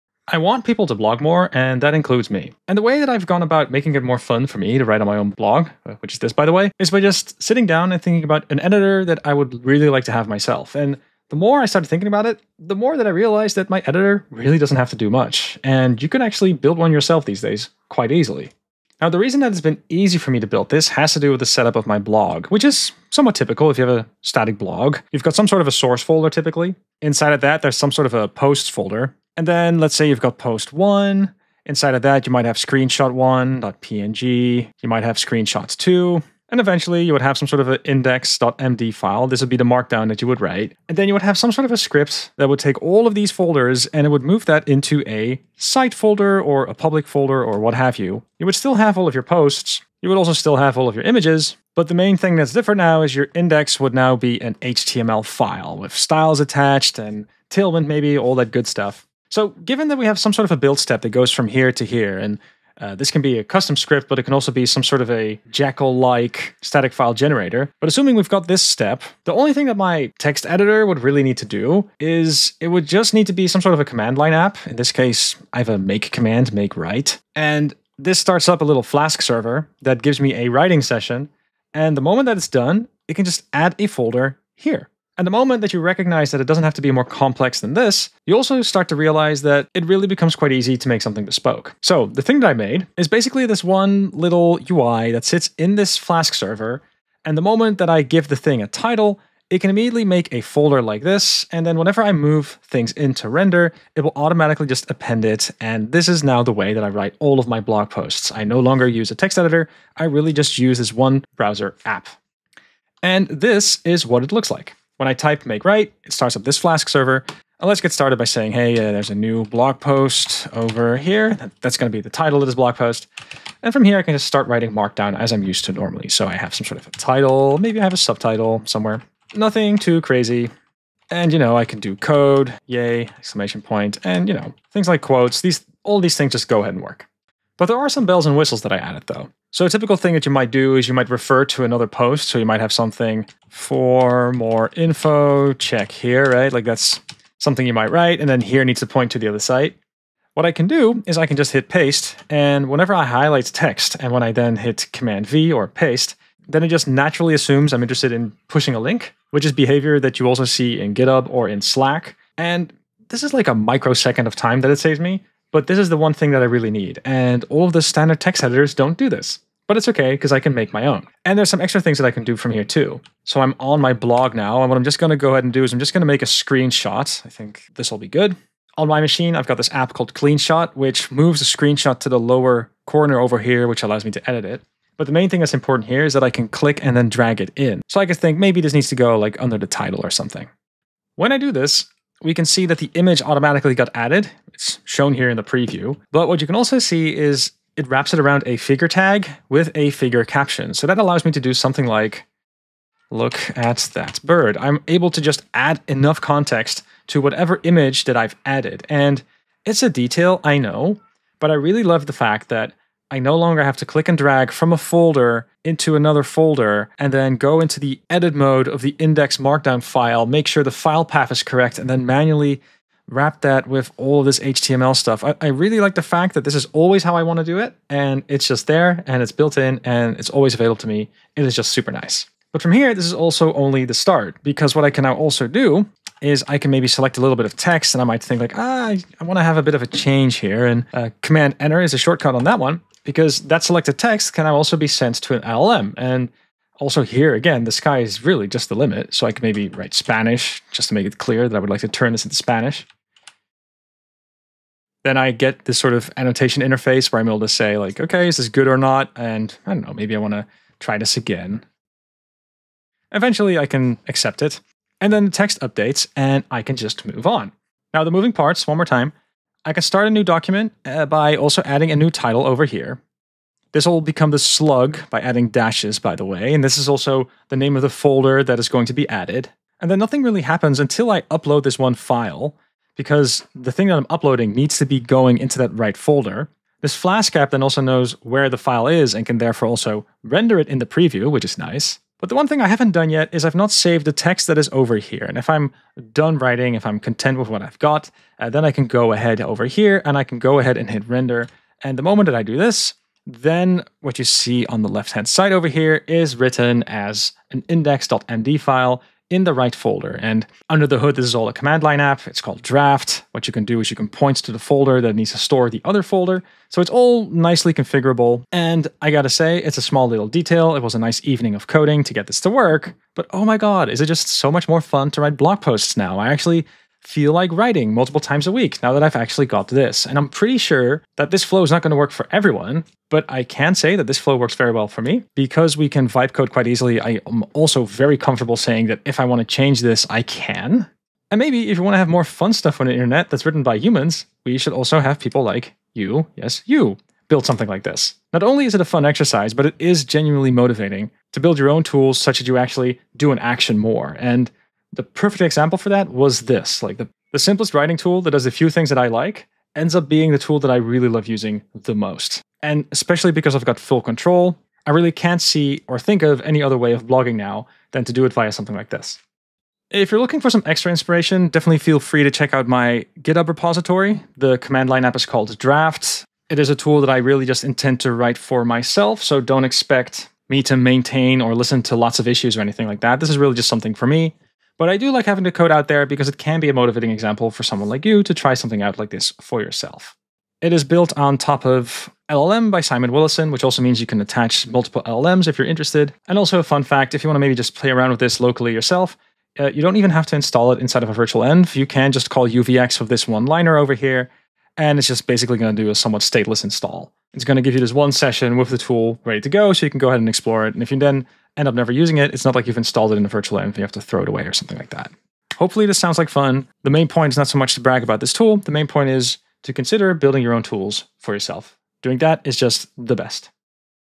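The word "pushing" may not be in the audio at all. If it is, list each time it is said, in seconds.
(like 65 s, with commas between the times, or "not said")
158 s.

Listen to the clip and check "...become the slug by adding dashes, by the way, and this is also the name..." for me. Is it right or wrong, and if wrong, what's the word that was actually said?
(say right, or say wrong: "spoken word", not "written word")
right.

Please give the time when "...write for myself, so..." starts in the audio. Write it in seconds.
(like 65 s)
378 s.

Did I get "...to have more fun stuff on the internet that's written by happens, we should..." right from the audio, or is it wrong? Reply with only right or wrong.
wrong.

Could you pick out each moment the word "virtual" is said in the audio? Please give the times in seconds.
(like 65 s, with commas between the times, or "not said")
401 s, 413 s.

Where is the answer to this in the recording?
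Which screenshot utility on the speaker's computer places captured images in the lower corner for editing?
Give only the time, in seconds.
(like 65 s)
180 s.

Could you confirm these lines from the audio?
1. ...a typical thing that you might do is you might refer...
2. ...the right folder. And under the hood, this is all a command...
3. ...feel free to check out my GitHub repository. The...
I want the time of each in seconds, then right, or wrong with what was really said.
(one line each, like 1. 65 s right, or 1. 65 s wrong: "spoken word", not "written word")
1. 139 s right
2. 309 s right
3. 371 s right.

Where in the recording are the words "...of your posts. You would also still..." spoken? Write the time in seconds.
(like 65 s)
49 s.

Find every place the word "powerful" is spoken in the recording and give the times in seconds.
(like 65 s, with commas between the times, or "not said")
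not said.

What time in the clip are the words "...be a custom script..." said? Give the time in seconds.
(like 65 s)
63 s.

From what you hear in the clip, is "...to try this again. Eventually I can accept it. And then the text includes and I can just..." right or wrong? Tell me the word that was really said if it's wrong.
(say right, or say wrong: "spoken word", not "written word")
wrong: "updates", not "includes".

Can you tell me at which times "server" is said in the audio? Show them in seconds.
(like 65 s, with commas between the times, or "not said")
79 s, 96 s, 116 s.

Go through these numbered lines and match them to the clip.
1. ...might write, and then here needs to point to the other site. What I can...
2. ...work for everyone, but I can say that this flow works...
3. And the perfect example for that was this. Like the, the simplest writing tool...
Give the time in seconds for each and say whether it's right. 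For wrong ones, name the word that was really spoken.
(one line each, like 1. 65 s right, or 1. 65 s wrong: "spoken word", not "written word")
1. 147 s right
2. 331 s right
3. 354 s right.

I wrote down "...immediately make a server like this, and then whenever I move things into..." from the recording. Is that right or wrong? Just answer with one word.
wrong.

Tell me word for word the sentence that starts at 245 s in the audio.
And also here, again, the sky is really just the limit.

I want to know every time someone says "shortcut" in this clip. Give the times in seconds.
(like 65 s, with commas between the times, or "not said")
241 s.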